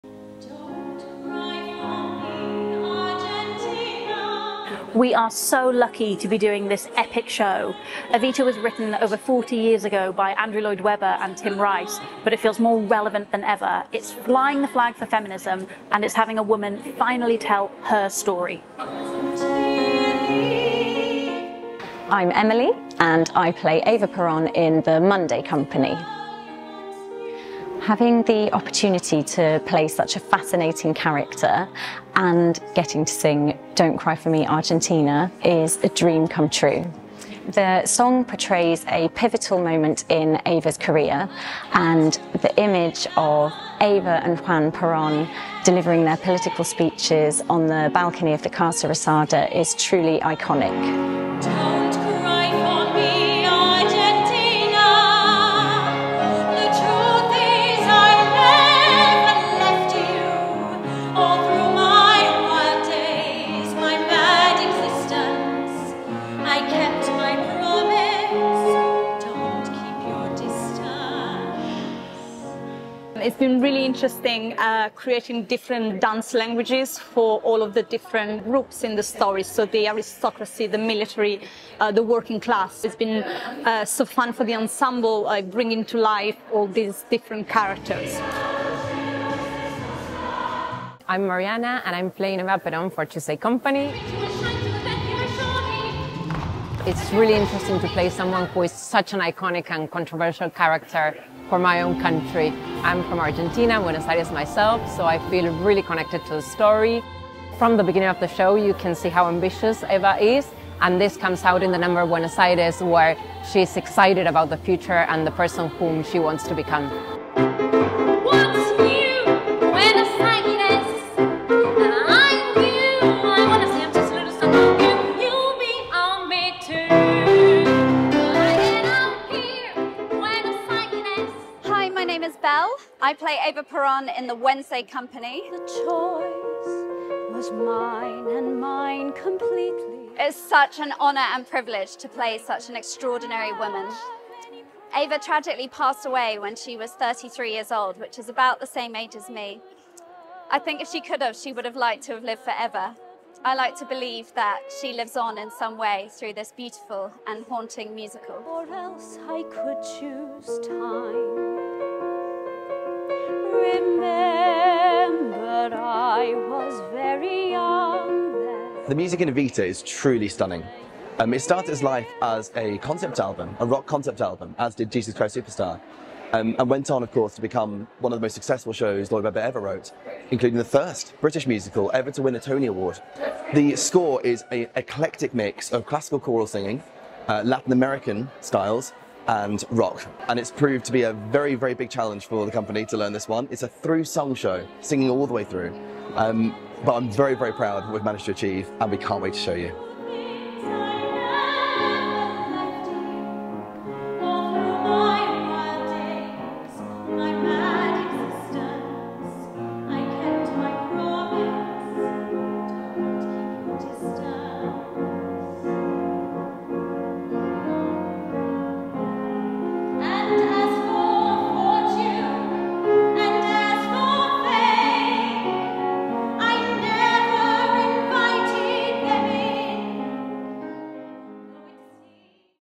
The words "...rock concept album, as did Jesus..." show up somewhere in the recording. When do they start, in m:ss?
2:53.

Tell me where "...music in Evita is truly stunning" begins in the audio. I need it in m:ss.
2:48.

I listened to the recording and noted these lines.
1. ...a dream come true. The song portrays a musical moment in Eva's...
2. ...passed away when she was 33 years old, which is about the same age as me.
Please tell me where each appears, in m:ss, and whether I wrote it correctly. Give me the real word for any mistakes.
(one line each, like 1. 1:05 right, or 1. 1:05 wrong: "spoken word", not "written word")
1. 0:35 wrong: "pivotal", not "musical"
2. 2:25 right.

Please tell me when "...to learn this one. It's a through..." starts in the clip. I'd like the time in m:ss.
3:12.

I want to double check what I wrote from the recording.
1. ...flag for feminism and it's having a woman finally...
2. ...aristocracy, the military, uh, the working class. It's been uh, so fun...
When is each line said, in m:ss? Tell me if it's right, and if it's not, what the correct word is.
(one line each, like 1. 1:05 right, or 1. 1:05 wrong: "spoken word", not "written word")
1. 0:14 right
2. 1:19 right.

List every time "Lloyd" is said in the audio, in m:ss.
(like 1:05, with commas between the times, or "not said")
0:10, 2:59.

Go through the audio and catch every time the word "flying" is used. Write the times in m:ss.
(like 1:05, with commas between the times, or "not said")
0:14.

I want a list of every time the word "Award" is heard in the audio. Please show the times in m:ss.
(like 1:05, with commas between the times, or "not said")
3:02.